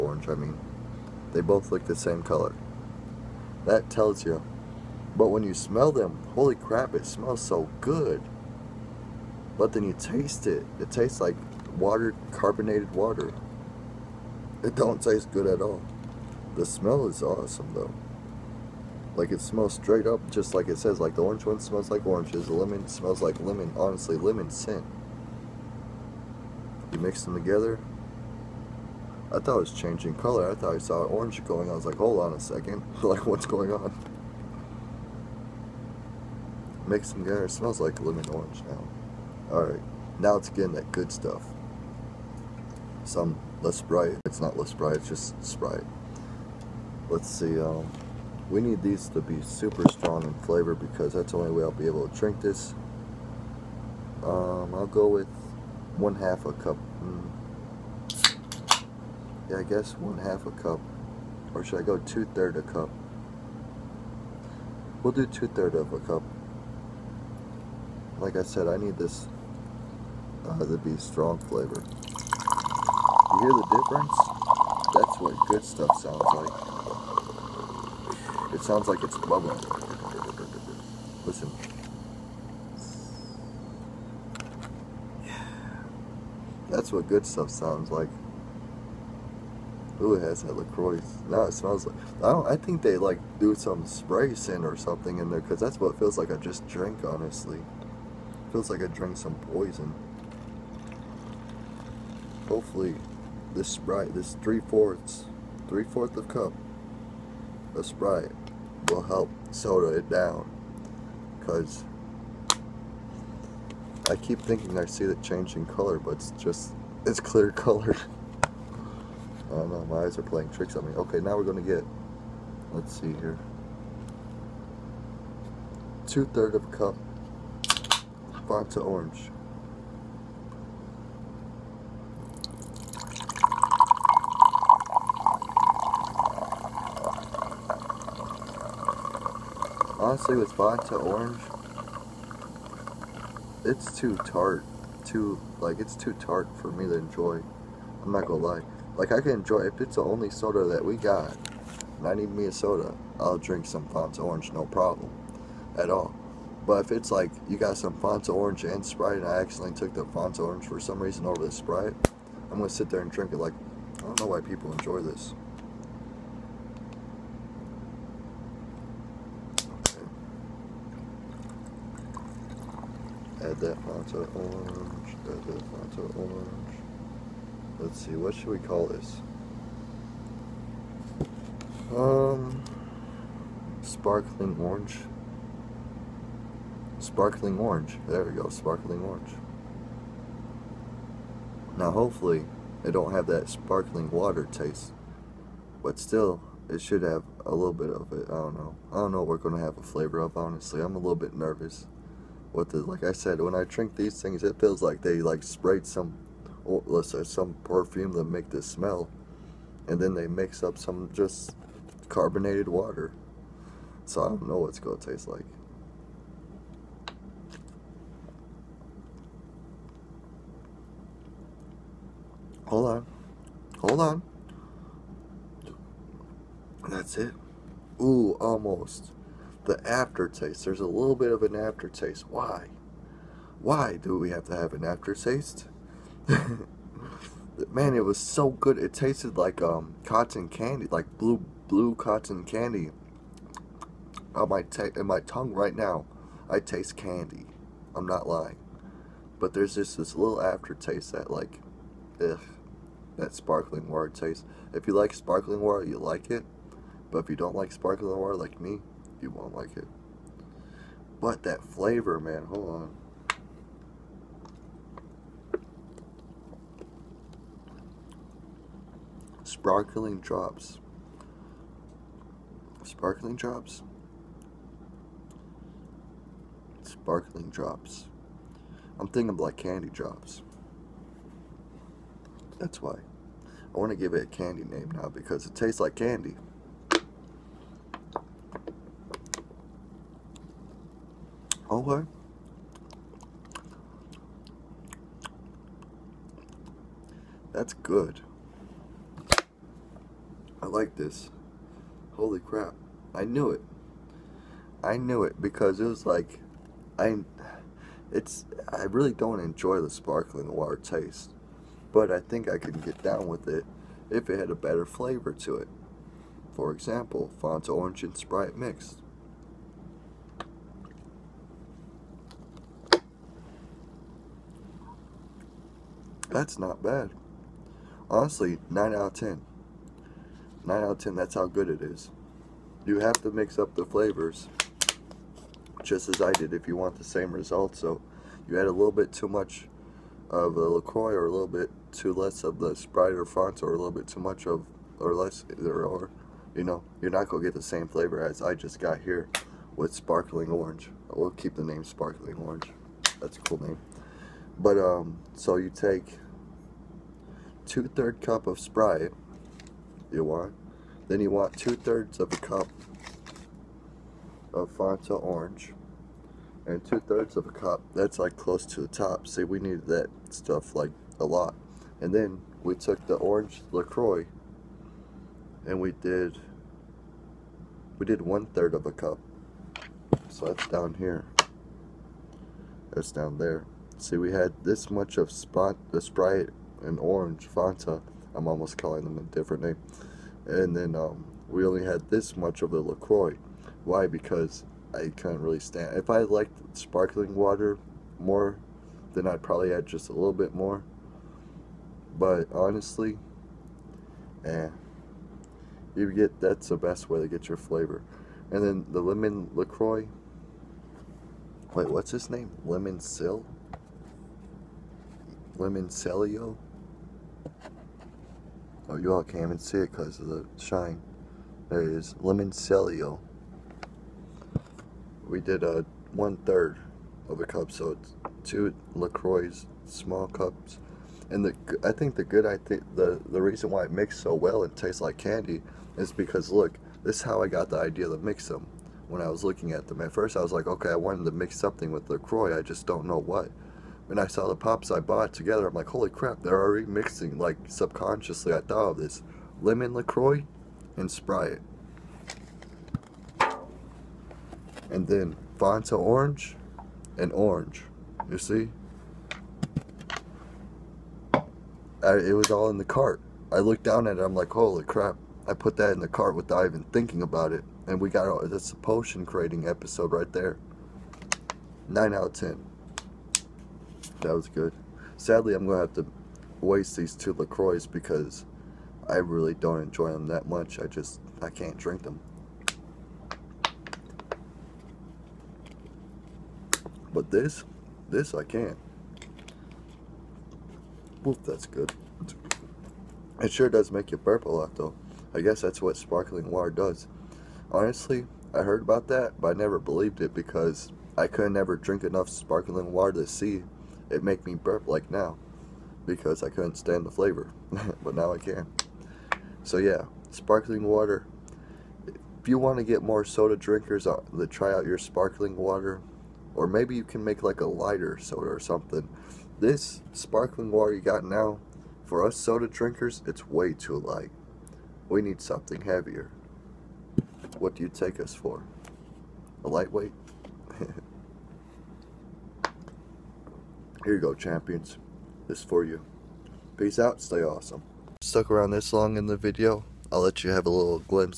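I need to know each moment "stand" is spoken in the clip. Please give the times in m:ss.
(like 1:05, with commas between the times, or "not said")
6:35, 8:26.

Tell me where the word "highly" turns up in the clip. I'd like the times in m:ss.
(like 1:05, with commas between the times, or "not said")
not said.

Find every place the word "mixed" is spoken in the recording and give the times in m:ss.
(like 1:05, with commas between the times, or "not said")
5:18, 7:13.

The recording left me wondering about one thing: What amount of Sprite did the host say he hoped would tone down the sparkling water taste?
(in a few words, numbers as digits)
3/4 cup.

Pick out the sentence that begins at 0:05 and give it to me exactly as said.
But when you smell them, holy crap, it smells so good.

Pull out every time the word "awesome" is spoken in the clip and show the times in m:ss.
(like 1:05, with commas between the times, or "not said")
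0:17, 8:57.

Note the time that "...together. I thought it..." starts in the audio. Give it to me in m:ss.
0:27.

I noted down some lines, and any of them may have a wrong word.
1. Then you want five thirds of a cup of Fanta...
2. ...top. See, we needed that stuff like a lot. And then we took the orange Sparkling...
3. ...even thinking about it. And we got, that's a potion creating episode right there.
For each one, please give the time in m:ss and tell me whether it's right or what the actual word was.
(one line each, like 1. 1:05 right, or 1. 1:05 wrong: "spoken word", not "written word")
1. 6:01 wrong: "two", not "five"
2. 6:08 wrong: "LaCroix", not "Sparkling"
3. 7:46 right.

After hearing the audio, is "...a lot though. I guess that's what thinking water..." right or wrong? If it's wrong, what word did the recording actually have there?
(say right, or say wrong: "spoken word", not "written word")
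wrong: "sparkling", not "thinking".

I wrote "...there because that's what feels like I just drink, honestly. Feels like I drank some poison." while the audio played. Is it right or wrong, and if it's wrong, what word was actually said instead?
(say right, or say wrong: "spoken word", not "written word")
right.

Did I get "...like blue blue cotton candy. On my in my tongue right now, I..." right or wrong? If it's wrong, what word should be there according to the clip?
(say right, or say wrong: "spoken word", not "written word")
right.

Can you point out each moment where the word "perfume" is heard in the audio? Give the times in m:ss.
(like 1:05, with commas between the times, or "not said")
3:27.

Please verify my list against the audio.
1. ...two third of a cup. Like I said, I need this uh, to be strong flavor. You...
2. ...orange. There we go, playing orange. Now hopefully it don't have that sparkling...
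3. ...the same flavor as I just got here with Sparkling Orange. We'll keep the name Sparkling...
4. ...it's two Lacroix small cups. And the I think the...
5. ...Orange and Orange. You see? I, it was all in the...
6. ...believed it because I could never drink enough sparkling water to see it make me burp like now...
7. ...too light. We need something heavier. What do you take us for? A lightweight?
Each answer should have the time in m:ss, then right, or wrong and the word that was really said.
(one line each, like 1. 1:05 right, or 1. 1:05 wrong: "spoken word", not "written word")
1. 1:05 right
2. 3:07 wrong: "sparkling", not "playing"
3. 5:47 right
4. 7:07 right
5. 7:35 right
6. 8:19 right
7. 8:43 right.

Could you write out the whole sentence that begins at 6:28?
I'm almost calling them a different name.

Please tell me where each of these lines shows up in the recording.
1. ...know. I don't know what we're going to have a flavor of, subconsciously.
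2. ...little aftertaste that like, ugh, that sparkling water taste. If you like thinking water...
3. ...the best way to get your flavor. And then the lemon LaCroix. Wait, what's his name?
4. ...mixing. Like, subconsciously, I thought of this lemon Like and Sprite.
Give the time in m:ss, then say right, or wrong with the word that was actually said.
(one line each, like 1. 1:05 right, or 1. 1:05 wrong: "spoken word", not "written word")
1. 3:18 wrong: "honestly", not "subconsciously"
2. 4:10 wrong: "sparkling", not "thinking"
3. 6:46 right
4. 7:26 wrong: "LaCroix", not "Like".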